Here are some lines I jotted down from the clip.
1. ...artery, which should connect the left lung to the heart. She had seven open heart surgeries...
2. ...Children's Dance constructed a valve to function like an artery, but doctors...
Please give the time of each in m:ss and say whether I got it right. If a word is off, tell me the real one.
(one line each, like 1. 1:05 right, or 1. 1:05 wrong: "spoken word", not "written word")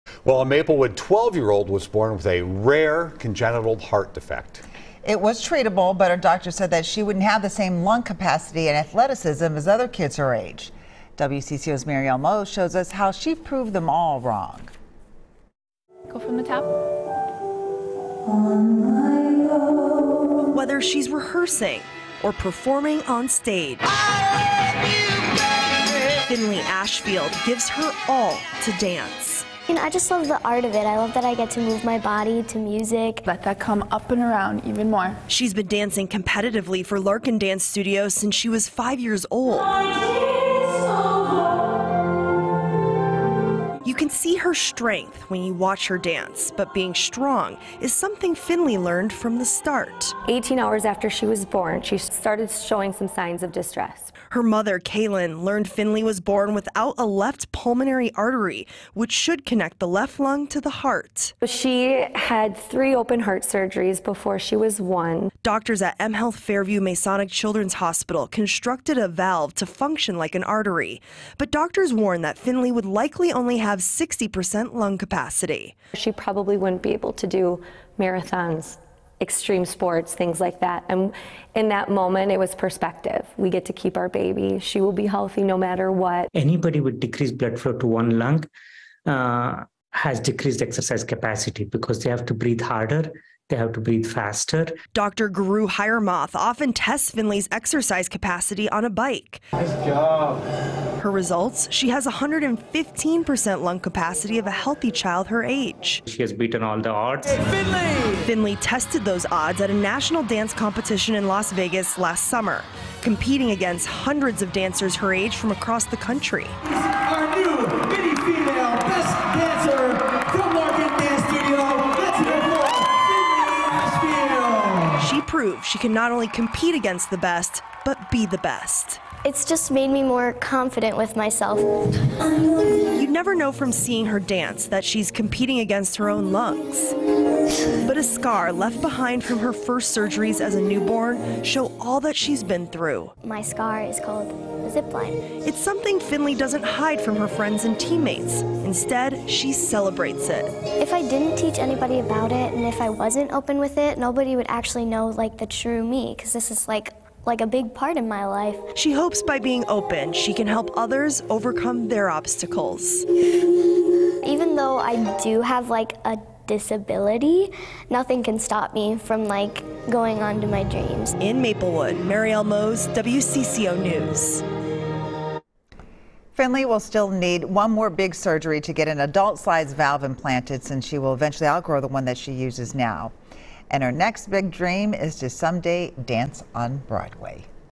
1. 0:58 wrong: "three", not "seven"
2. 1:07 wrong: "Hospital", not "Dance".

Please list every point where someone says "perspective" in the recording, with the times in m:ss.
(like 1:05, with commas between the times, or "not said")
1:22.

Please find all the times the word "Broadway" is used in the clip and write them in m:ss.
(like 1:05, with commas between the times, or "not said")
3:06.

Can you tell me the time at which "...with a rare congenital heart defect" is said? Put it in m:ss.
0:02.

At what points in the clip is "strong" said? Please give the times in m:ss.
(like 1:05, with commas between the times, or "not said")
0:46.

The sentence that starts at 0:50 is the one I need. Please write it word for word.
18 hours after she was born, she started showing some signs of distress.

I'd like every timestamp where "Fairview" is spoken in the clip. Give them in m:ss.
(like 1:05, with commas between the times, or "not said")
1:06.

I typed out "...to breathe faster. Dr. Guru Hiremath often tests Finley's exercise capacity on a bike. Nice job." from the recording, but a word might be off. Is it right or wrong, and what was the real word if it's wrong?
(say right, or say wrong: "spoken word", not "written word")
right.